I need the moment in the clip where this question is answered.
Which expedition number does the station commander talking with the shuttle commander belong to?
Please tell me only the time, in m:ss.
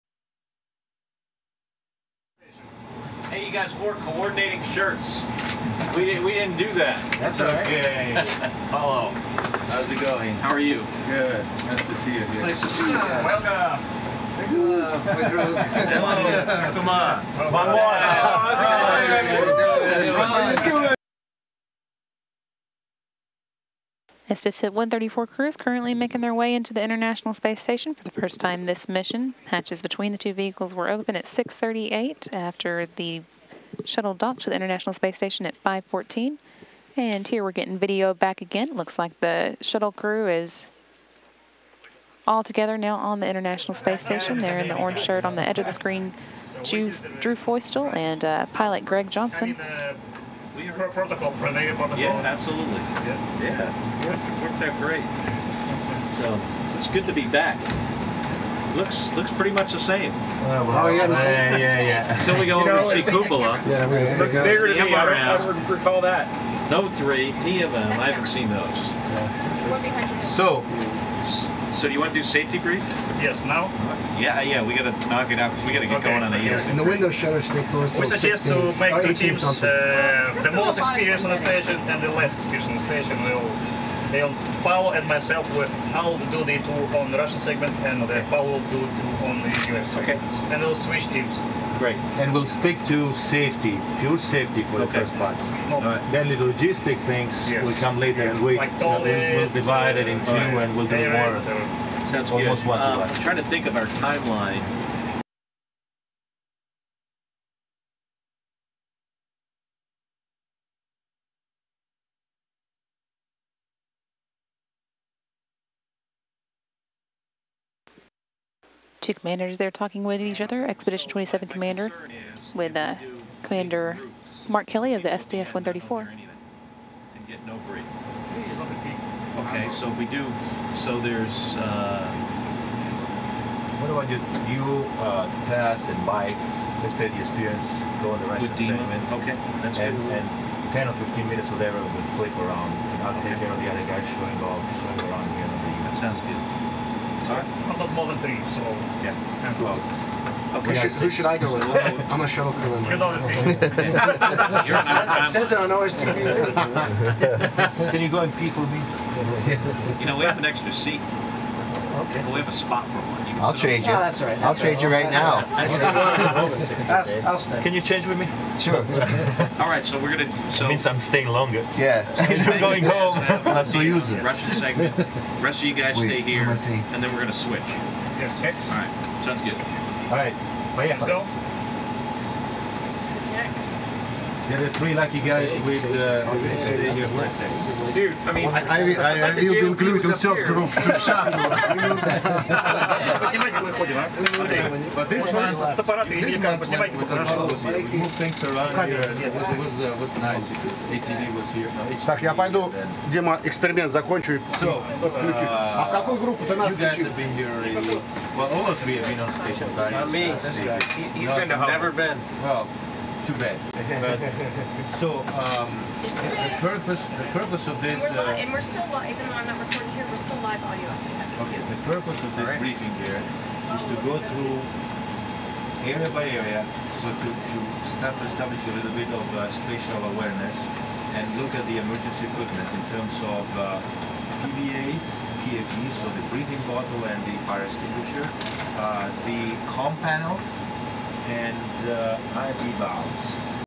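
2:01.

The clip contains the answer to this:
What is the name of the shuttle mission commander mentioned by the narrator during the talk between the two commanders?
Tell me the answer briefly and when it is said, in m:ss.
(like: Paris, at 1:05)
Mark Kelly, at 2:04.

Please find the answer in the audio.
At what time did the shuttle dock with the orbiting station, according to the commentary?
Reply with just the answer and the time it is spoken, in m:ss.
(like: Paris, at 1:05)
5:14, at 0:35.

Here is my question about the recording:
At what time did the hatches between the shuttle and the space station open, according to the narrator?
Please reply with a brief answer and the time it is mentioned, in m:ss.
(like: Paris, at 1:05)
6:38, at 0:31.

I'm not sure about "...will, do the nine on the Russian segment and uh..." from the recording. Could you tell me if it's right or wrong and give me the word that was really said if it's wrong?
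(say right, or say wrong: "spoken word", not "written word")
wrong: "two", not "nine".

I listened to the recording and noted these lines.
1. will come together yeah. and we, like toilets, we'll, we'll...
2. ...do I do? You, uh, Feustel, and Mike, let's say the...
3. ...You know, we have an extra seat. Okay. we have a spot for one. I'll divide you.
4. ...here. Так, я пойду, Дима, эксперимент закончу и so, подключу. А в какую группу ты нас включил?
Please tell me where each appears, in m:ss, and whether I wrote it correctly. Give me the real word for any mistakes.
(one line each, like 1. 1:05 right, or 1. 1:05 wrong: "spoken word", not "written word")
1. 1:37 wrong: "later", not "together"
2. 2:13 wrong: "Tess", not "Feustel"
3. 2:40 wrong: "trade", not "divide"
4. 3:21 right.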